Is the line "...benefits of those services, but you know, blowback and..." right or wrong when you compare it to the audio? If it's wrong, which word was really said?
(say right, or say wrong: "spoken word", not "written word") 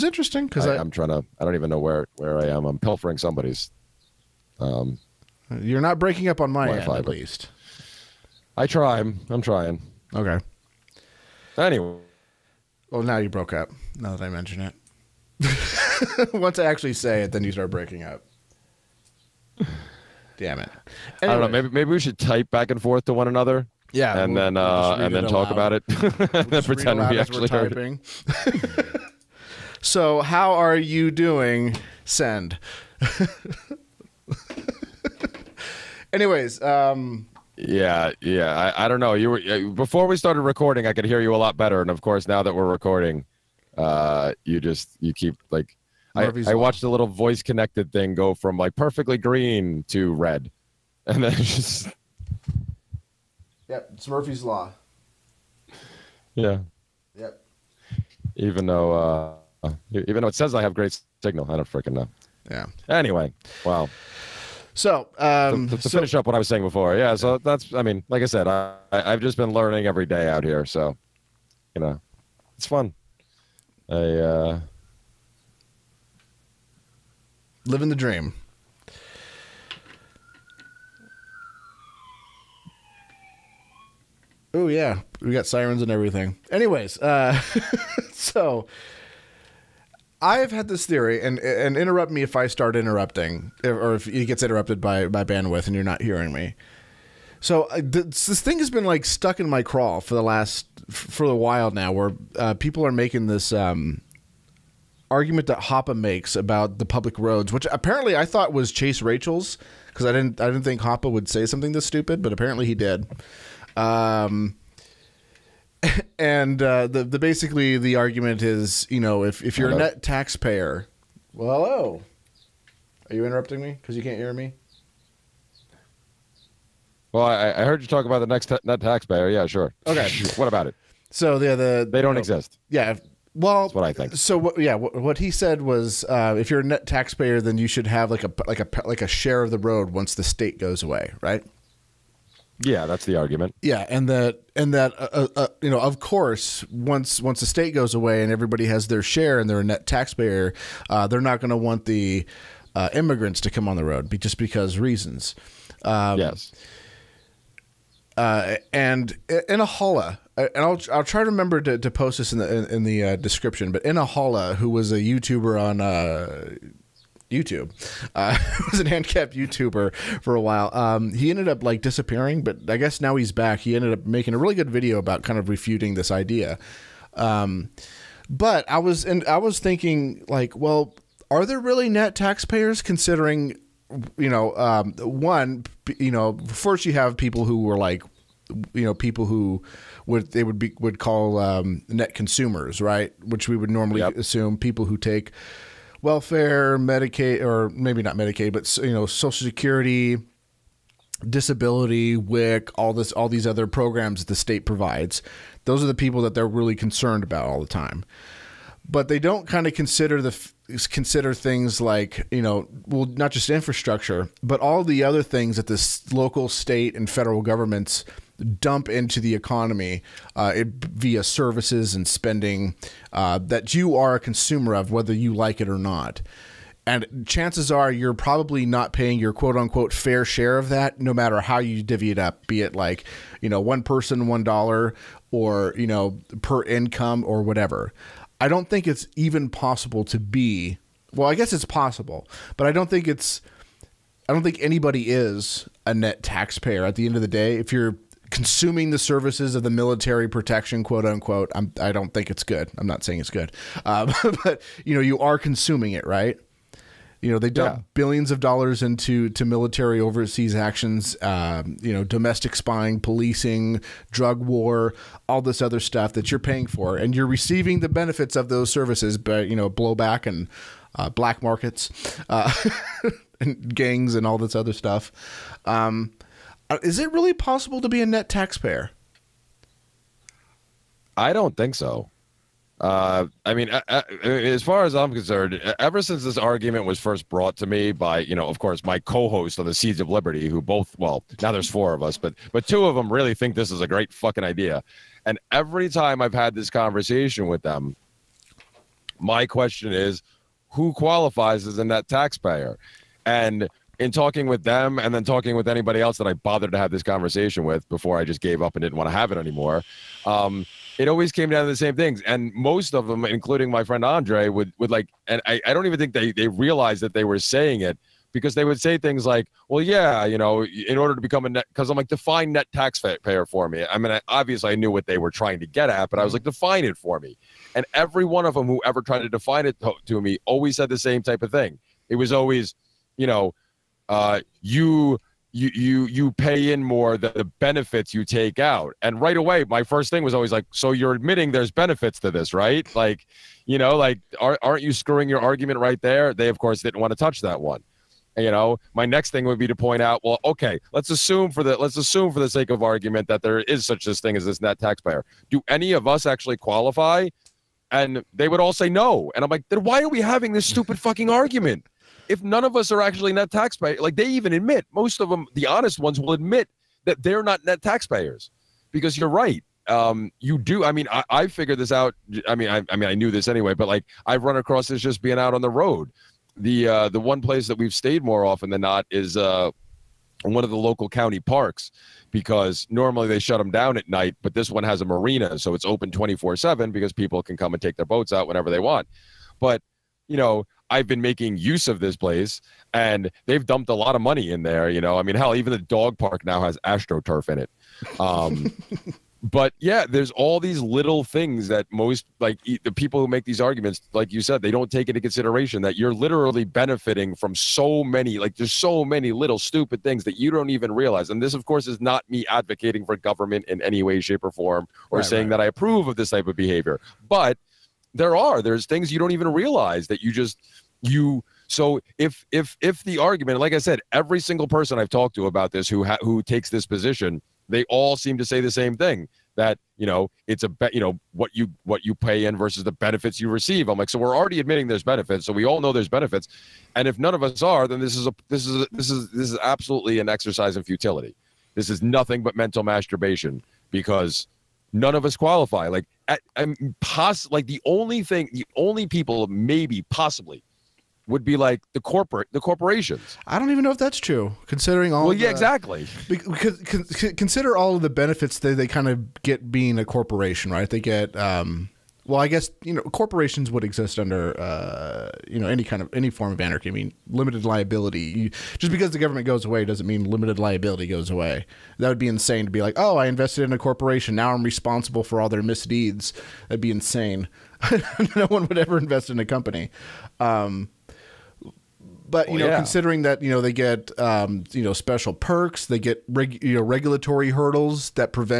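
right.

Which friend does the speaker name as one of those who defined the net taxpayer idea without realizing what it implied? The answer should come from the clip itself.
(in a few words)
Andre.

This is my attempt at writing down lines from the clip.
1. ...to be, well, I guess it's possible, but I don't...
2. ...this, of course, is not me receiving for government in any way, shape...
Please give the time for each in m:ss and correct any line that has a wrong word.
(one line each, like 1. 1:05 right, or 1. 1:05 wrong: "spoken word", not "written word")
1. 4:00 right
2. 6:51 wrong: "advocating", not "receiving".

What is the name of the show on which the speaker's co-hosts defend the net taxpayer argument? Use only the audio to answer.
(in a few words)
Seeds of Liberty.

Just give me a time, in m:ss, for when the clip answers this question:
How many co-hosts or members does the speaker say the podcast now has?
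4:51.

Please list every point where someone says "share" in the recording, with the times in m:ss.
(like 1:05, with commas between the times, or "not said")
2:19, 2:29, 3:50.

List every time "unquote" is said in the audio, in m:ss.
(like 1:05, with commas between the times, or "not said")
3:49, 4:11.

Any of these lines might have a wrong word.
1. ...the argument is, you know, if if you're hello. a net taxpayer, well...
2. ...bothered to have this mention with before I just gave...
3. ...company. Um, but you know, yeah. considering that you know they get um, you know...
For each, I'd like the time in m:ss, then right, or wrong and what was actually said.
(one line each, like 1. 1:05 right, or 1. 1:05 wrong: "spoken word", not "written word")
1. 1:57 right
2. 5:06 wrong: "conversation", not "mention"
3. 7:59 right.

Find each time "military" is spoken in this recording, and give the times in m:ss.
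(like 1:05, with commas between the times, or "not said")
4:09, 4:19.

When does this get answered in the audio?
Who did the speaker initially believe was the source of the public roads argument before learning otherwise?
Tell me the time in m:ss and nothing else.
1:48.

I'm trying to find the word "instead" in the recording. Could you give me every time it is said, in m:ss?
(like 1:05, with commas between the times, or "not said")
not said.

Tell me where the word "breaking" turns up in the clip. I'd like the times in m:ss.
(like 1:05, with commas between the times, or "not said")
0:05, 0:17.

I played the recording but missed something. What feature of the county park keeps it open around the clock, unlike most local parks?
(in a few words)
A marina.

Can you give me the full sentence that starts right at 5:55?
Do any of us actually qualify?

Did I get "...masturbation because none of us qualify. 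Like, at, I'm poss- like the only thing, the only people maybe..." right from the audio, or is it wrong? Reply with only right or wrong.
right.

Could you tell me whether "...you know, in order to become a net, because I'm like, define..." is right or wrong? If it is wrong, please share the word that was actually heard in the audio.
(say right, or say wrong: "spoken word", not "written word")
right.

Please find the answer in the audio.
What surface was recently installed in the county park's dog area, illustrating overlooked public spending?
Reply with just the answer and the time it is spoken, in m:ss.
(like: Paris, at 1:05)
Astroturf, at 6:36.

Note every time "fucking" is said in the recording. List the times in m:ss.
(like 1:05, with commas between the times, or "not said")
4:54, 6:00.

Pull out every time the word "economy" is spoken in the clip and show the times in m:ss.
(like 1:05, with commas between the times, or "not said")
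3:39.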